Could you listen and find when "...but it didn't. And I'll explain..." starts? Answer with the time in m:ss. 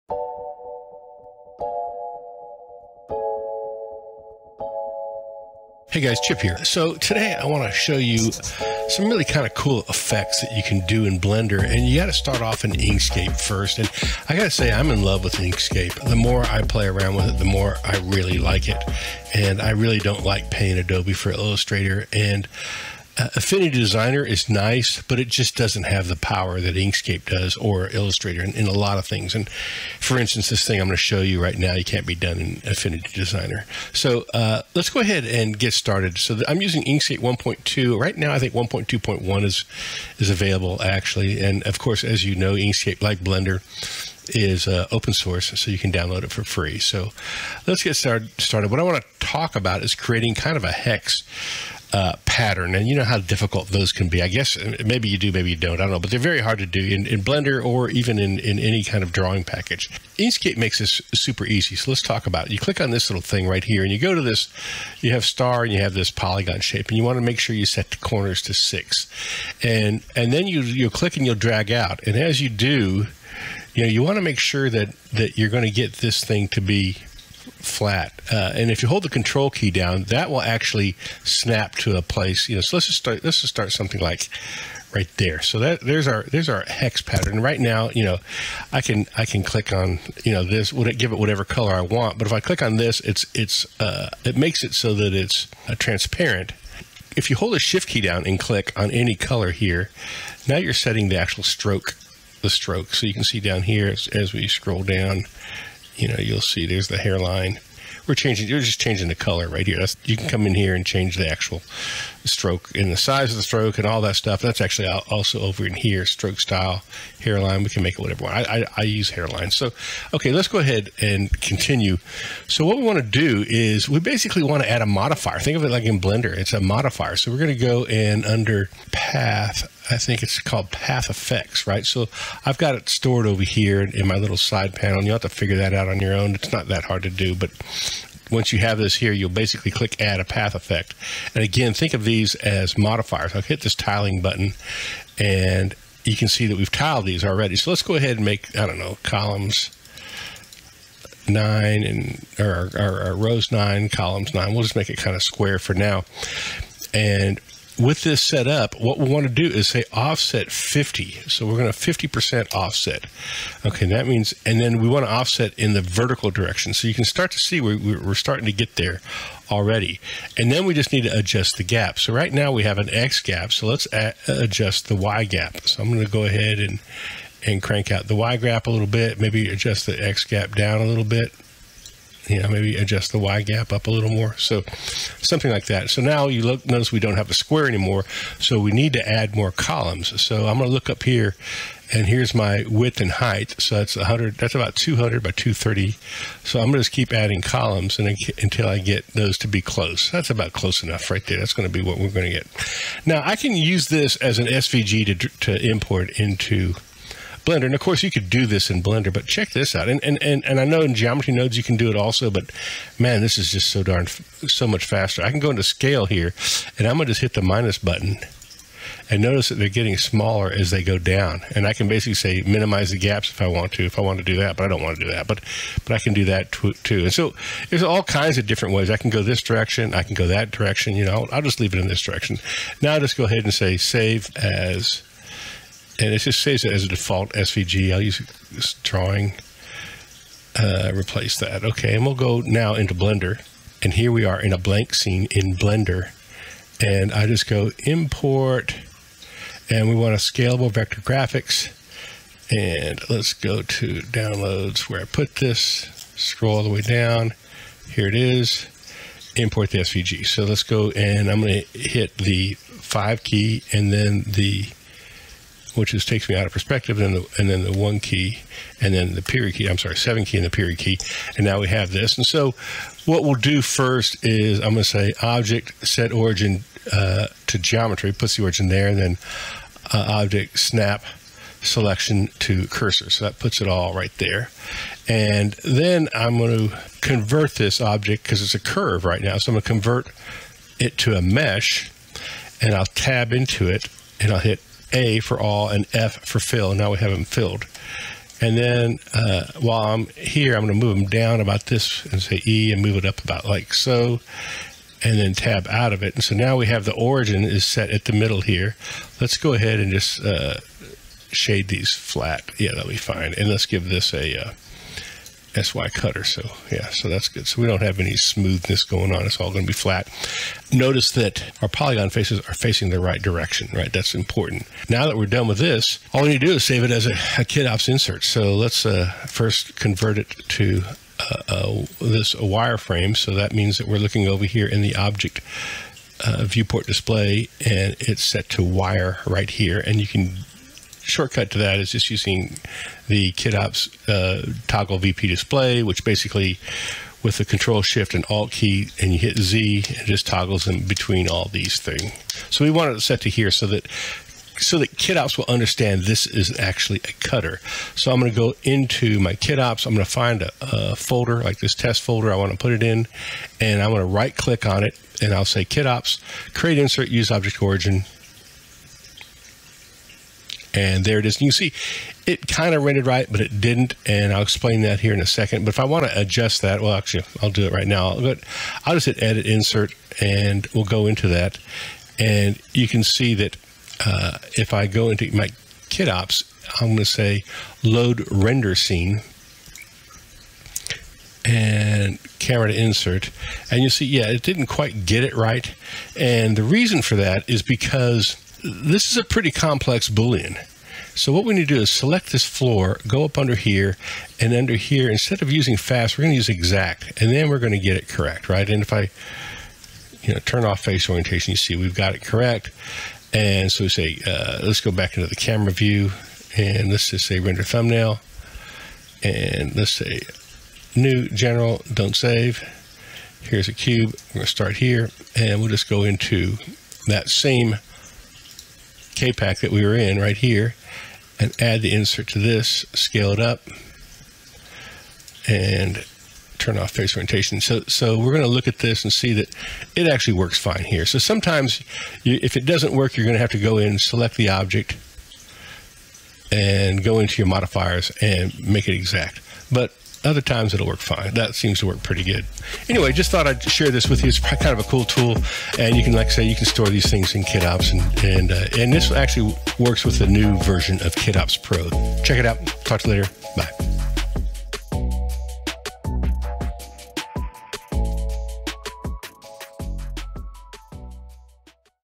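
6:13.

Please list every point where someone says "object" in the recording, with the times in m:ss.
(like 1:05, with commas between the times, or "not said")
4:35, 4:40, 4:47, 5:34, 6:07, 7:24.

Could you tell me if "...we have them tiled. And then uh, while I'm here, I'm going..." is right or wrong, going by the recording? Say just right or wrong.
wrong.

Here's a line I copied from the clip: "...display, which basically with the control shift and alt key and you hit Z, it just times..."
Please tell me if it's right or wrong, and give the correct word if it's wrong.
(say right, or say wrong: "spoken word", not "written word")
wrong: "toggles", not "times".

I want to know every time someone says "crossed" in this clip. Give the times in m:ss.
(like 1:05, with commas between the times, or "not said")
not said.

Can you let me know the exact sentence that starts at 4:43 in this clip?
So that puts it all right there.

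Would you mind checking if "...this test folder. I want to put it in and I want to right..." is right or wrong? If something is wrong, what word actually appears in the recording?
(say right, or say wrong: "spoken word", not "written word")
right.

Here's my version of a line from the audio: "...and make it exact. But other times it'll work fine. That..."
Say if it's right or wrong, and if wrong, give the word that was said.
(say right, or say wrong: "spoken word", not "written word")
right.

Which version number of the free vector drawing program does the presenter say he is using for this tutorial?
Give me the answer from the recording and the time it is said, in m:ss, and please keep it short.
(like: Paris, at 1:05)
1.2, at 0:36.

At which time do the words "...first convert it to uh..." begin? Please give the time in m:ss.
5:29.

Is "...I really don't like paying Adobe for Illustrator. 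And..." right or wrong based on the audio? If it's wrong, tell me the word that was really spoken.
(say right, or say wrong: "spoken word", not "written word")
right.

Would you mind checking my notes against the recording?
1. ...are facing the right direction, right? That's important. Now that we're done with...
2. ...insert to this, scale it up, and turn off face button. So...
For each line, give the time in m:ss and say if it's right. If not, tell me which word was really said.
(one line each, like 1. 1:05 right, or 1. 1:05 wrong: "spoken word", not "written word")
1. 5:22 right
2. 7:11 wrong: "orientation", not "button".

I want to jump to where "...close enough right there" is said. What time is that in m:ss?
3:20.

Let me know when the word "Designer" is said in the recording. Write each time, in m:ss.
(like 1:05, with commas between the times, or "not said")
0:23, 0:33.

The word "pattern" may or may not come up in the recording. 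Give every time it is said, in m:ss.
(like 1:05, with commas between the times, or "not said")
0:52, 1:27.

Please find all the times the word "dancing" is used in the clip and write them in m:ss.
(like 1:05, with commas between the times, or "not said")
not said.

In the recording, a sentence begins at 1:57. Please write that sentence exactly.
We can make it whatever I, I, I use hairline.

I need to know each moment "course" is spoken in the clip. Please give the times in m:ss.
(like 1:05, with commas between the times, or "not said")
0:41, 3:27.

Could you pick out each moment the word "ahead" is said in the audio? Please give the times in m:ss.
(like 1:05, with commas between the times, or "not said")
0:35, 2:00, 2:27, 2:56, 3:53, 5:09.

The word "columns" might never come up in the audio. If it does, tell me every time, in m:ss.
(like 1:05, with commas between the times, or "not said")
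2:29, 2:33, 3:09, 3:17.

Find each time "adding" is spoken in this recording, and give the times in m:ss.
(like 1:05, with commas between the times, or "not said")
3:17.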